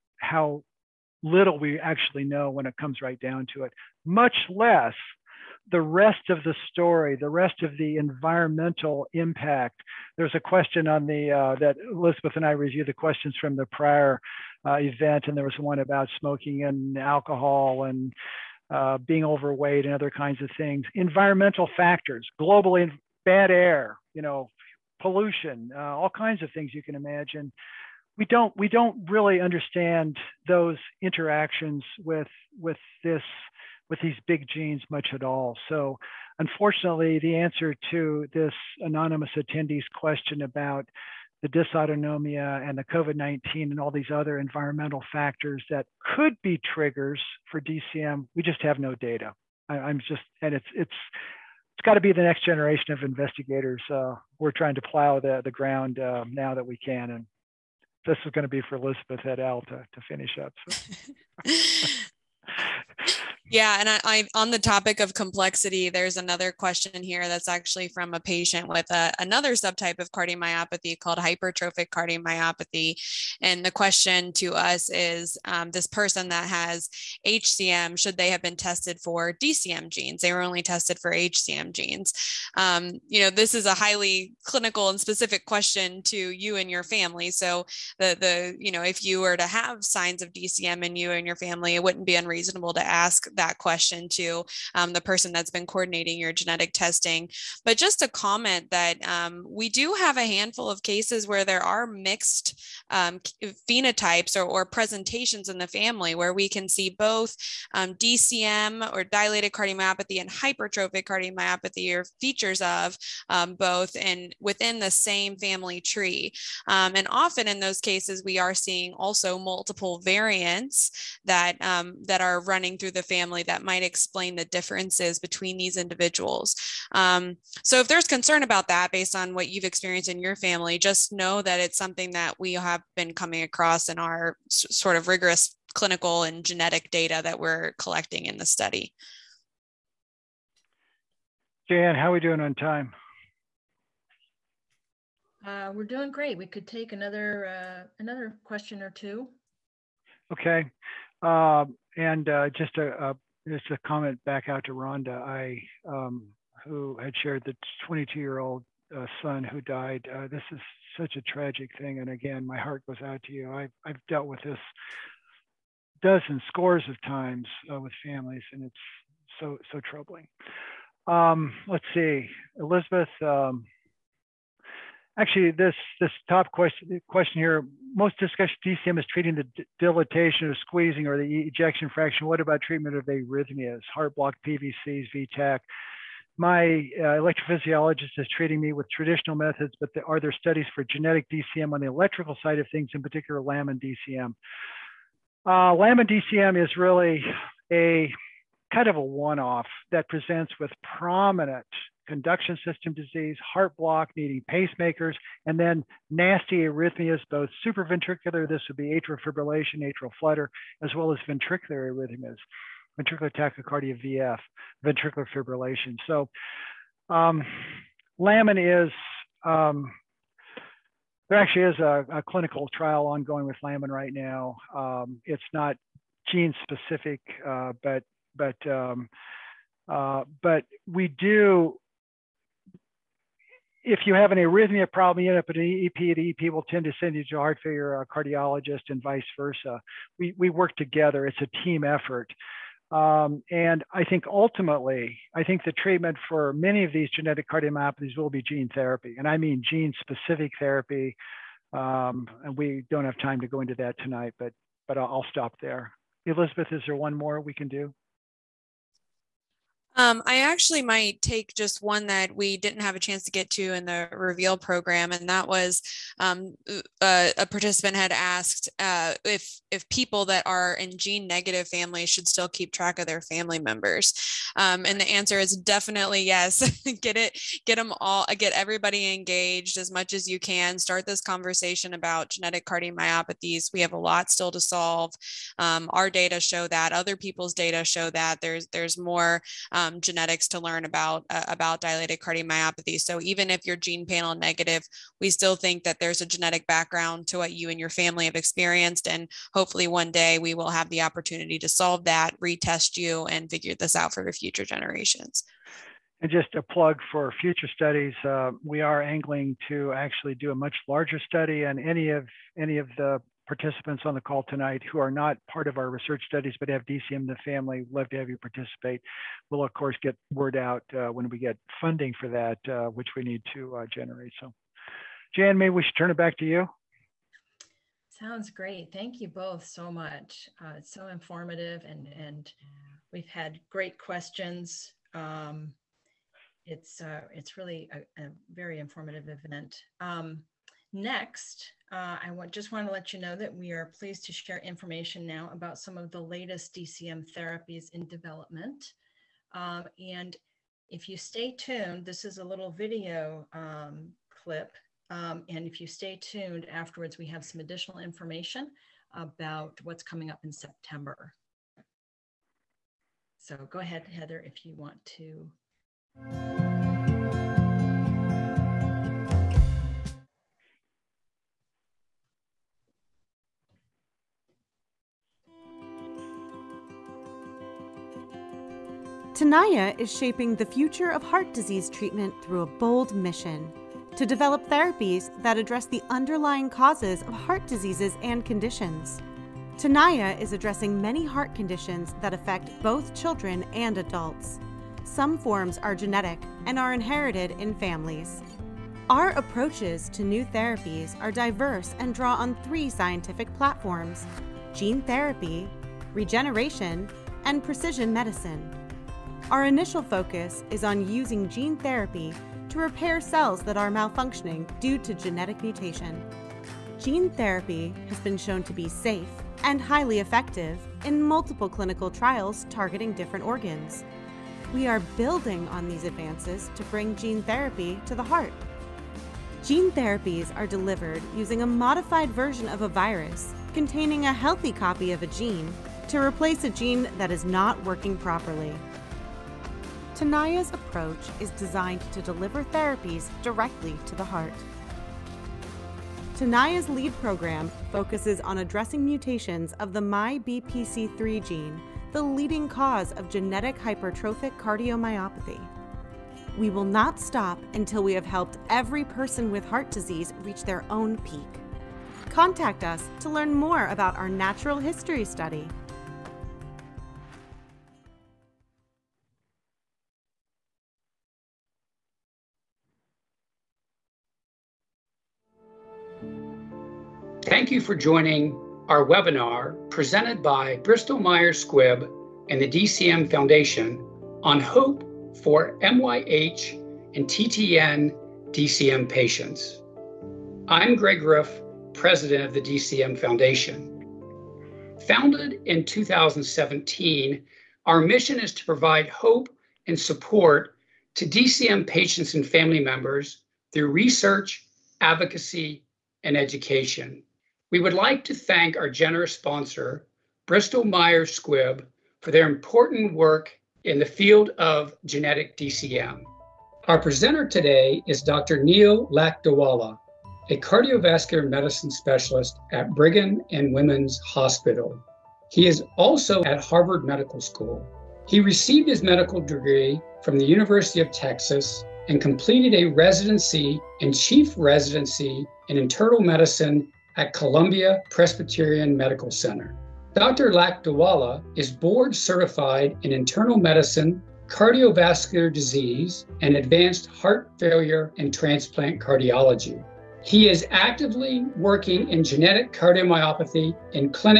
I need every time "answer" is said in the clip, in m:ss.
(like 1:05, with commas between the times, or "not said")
0:37, 4:35.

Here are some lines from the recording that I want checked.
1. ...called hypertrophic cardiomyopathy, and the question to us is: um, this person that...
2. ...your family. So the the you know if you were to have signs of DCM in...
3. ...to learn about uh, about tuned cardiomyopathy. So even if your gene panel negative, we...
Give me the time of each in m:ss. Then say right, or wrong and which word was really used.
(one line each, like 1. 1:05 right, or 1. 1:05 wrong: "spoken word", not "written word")
1. 1:10 right
2. 1:26 right
3. 4:50 wrong: "dilated", not "tuned".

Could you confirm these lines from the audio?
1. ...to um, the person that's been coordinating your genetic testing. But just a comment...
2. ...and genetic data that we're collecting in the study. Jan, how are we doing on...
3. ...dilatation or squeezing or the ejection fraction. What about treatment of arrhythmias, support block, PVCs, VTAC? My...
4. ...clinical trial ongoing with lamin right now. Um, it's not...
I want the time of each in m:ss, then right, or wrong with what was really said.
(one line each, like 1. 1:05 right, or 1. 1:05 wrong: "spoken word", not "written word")
1. 1:34 right
2. 2:16 right
3. 2:59 wrong: "heart", not "support"
4. 3:42 right.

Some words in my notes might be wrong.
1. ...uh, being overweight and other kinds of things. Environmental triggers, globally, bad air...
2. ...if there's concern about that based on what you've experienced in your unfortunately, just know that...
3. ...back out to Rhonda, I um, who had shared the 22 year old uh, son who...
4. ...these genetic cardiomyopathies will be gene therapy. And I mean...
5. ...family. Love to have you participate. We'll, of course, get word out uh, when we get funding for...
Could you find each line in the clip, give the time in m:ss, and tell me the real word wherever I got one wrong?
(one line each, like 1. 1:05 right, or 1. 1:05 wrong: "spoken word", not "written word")
1. 0:18 wrong: "factors", not "triggers"
2. 2:07 wrong: "family", not "unfortunately"
3. 2:34 right
4. 4:06 right
5. 5:17 right.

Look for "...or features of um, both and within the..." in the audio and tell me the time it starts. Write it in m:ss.
1:51.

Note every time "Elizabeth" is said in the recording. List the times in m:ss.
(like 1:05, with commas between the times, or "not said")
0:11, 0:58, 2:52, 4:16.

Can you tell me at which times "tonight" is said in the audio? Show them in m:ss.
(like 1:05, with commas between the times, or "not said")
4:13, 5:14.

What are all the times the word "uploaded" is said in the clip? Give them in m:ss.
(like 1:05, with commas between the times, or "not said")
not said.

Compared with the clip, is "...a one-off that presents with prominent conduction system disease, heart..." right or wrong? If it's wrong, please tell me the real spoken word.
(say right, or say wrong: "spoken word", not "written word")
right.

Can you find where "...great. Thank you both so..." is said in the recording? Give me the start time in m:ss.
5:28.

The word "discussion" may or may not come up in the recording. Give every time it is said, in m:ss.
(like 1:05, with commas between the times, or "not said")
2:58.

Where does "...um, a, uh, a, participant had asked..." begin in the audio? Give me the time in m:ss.
4:26.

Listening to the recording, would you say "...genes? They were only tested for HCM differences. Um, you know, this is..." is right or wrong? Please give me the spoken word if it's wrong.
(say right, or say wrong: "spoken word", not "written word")
wrong: "genes", not "differences".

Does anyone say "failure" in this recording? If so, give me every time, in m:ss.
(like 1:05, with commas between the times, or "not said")
3:57, 9:07.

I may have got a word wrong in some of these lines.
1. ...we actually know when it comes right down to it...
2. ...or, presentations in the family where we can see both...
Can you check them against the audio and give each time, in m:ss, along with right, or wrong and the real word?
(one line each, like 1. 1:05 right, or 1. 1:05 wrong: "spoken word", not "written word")
1. 0:01 right
2. 1:44 right.